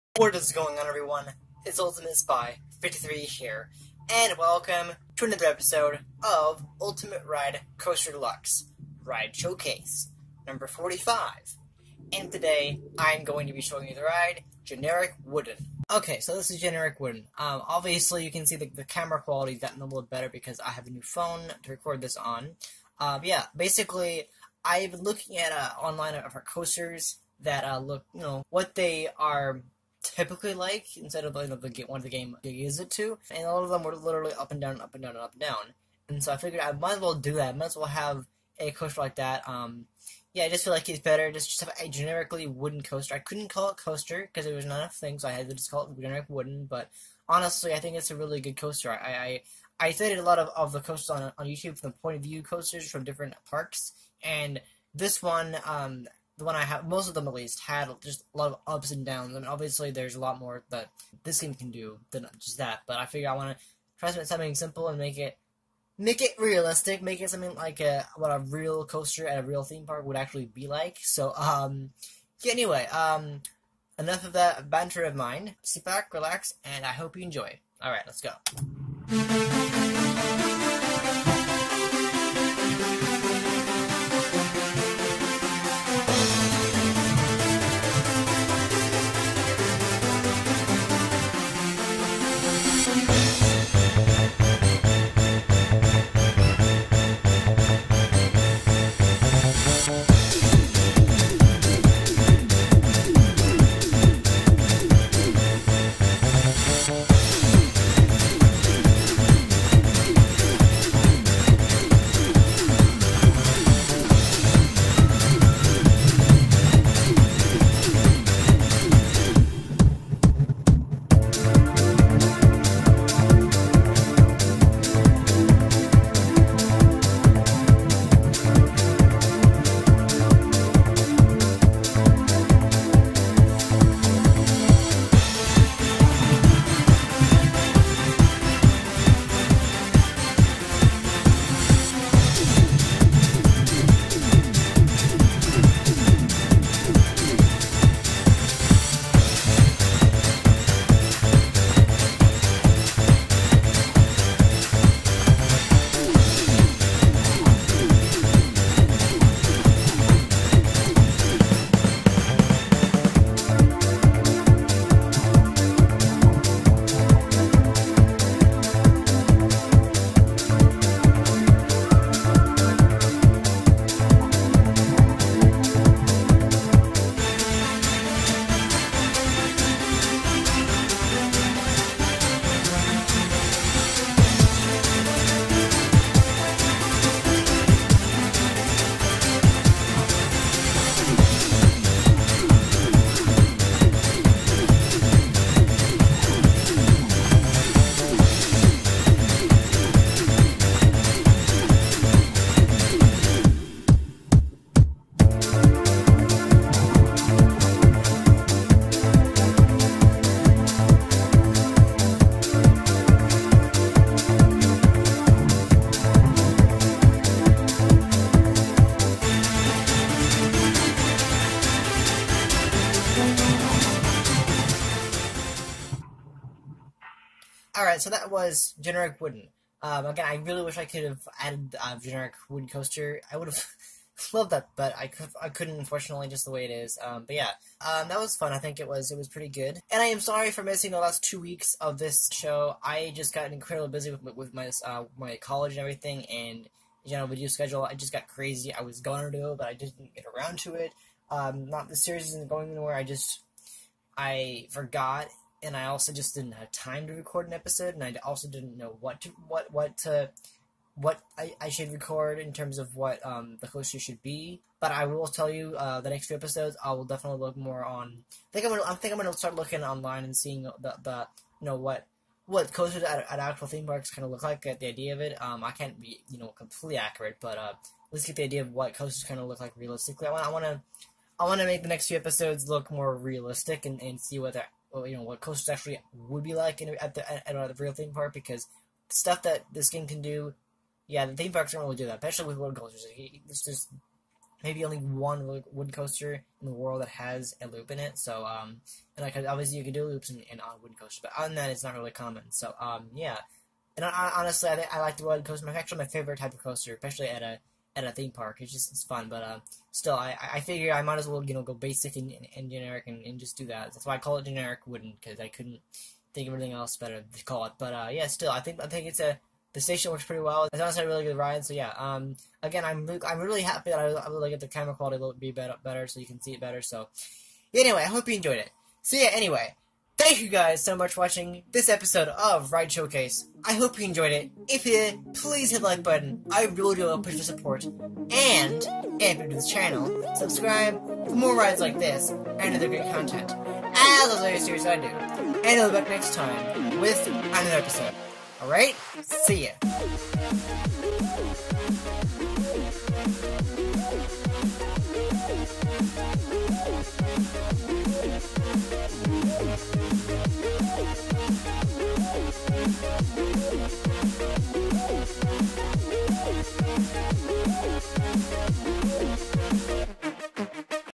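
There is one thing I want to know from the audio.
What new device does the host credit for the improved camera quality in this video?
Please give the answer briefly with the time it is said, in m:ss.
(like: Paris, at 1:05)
New phone, at 0:20.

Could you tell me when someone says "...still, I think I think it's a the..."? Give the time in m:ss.
5:18.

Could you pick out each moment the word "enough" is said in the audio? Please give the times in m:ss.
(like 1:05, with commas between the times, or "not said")
0:44, 1:13.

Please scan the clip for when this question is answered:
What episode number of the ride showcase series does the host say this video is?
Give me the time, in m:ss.
0:10.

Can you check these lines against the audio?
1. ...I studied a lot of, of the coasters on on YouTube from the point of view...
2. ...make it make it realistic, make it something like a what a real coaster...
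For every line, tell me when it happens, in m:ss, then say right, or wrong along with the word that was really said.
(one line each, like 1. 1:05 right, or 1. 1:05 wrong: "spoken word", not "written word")
1. 0:49 right
2. 1:04 right.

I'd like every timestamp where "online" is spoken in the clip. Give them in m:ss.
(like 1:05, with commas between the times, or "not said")
0:25, 4:29.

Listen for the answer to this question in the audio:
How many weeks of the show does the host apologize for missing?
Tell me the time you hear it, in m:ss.
4:01.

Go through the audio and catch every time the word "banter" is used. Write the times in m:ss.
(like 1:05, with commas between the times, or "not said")
1:14.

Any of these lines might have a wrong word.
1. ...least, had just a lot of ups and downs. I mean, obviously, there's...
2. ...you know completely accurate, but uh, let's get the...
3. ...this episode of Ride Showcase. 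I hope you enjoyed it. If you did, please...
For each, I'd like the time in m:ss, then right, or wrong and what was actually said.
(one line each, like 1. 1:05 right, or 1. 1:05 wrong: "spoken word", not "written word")
1. 0:57 right
2. 4:36 right
3. 5:31 right.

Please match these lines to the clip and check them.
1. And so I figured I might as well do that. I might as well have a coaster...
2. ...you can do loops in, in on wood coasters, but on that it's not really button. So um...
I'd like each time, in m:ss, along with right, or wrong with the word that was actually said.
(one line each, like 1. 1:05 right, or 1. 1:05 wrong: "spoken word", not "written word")
1. 0:36 right
2. 4:59 wrong: "common", not "button".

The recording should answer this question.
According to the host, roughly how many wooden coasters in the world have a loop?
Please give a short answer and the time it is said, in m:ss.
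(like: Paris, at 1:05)
1, at 4:54.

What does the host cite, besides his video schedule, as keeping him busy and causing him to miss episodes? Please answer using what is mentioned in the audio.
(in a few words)
College.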